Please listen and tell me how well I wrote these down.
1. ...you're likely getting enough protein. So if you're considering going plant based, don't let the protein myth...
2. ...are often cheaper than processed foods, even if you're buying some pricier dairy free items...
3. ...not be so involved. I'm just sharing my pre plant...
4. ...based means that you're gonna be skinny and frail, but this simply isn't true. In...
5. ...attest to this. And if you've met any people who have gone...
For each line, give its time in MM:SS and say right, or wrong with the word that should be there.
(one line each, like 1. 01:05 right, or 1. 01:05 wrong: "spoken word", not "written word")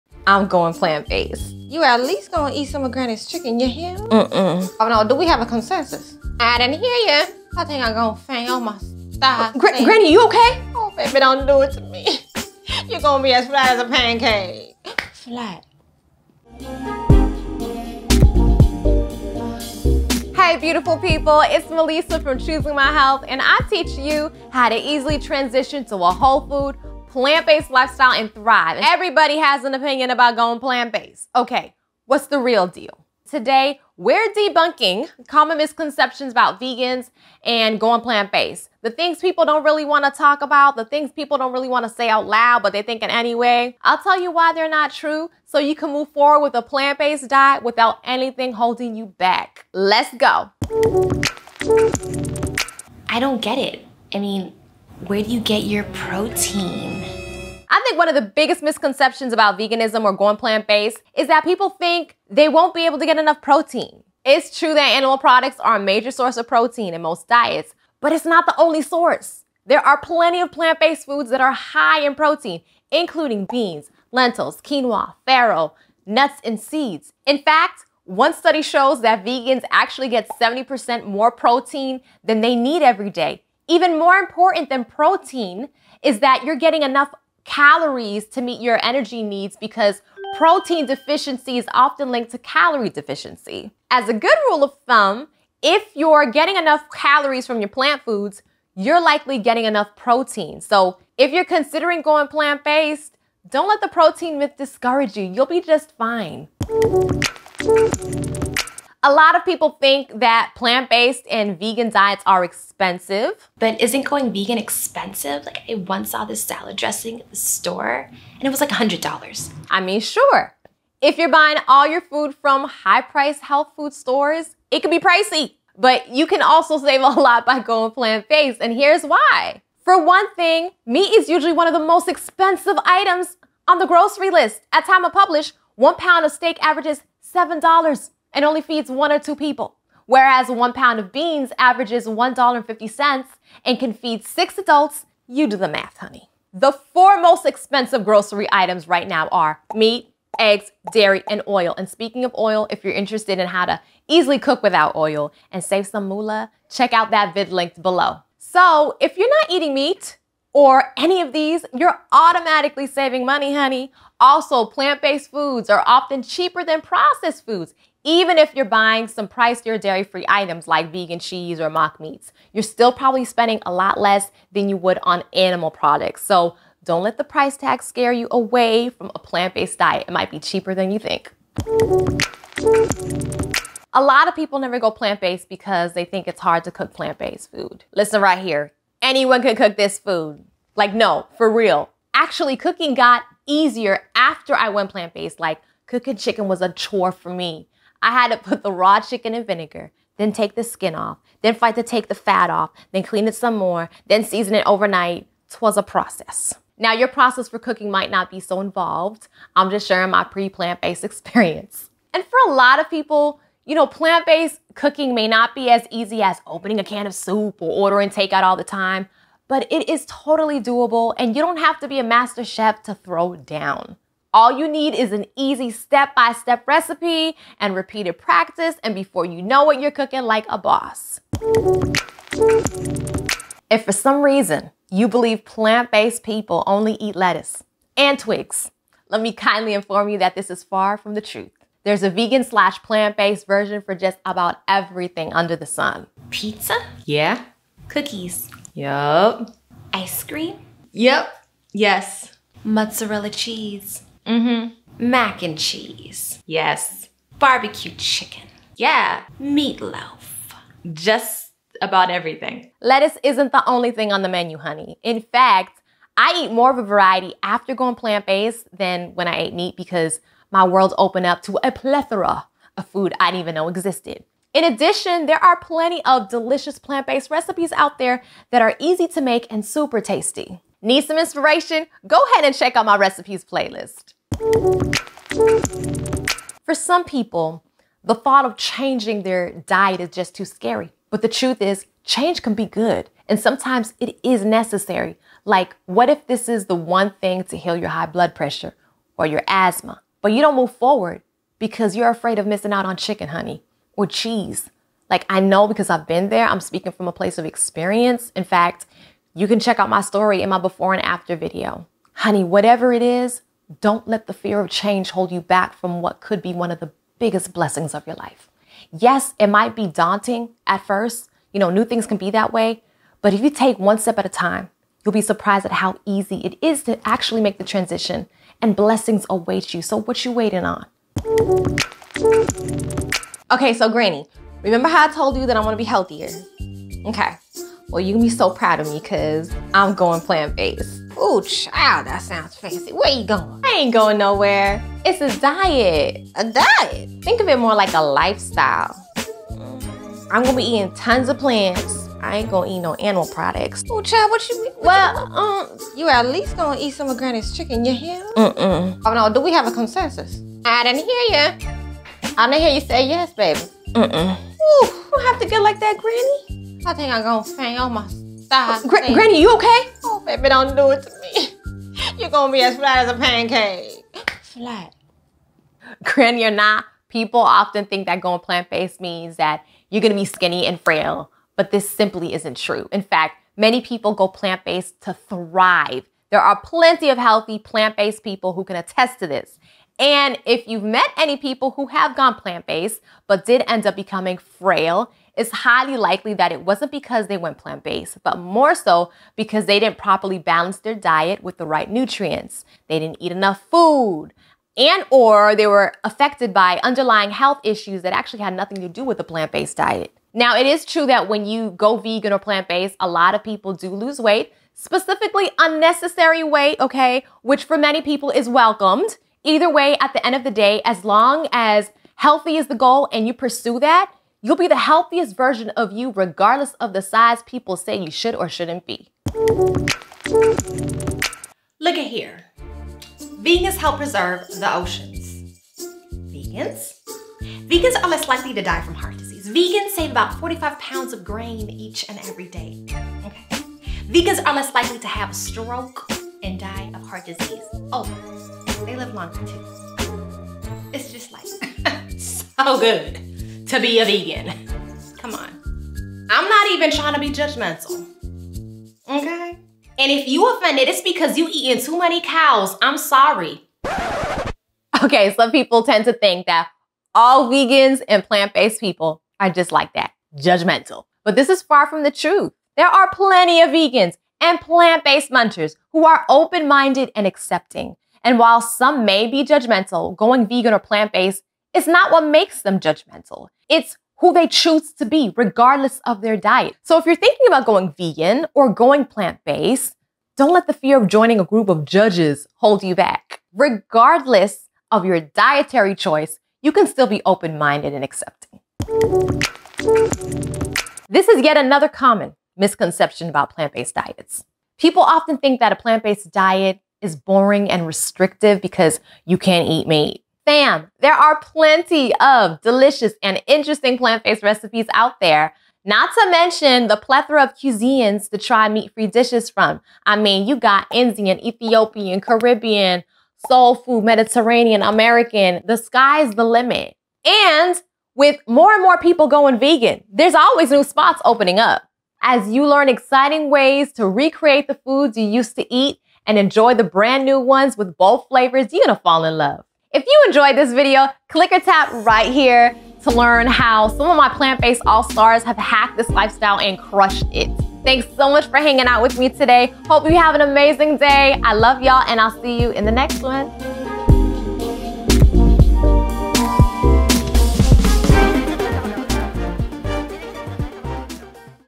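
1. 01:38 right
2. 02:45 right
3. 03:28 right
4. 06:18 right
5. 06:28 right.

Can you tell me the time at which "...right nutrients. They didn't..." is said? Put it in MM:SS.
06:41.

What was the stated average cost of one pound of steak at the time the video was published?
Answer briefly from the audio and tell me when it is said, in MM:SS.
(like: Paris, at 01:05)
$7, at 02:17.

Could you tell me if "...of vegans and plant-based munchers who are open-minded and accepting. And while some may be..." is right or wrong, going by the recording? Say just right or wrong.
right.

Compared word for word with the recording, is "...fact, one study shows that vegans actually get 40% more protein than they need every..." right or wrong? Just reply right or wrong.
wrong.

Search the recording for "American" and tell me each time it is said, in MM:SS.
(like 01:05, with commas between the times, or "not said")
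08:44.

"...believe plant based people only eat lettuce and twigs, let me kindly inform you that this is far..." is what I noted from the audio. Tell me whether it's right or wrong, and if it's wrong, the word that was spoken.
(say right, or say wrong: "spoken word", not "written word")
right.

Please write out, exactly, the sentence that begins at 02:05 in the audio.
But you can also save a lot by going plant based, and here's why.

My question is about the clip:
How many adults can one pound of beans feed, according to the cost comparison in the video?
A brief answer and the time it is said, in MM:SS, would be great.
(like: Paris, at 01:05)
6, at 02:24.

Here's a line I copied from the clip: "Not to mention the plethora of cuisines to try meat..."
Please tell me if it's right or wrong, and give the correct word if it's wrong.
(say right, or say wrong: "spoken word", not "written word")
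right.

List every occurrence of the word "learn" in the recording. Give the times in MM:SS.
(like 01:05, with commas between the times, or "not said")
08:52, 09:03.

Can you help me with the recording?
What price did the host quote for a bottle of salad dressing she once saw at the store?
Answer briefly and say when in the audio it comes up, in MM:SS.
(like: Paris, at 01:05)
$100, at 01:58.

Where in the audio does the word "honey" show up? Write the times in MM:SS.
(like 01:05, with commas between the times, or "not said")
02:25, 02:43, 04:24, 05:03, 05:12.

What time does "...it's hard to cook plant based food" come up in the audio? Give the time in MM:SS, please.
03:06.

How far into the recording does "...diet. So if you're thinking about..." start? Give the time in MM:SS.
08:06.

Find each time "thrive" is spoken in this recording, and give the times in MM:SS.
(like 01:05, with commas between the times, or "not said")
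00:28, 06:25.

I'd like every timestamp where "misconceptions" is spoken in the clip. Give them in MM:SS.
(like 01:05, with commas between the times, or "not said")
00:35, 00:58, 08:22.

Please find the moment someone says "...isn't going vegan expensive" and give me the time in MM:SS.
01:53.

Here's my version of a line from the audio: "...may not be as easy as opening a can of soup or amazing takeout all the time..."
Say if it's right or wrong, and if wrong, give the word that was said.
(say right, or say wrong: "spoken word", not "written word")
wrong: "ordering", not "amazing".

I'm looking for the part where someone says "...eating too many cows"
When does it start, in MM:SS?
07:41.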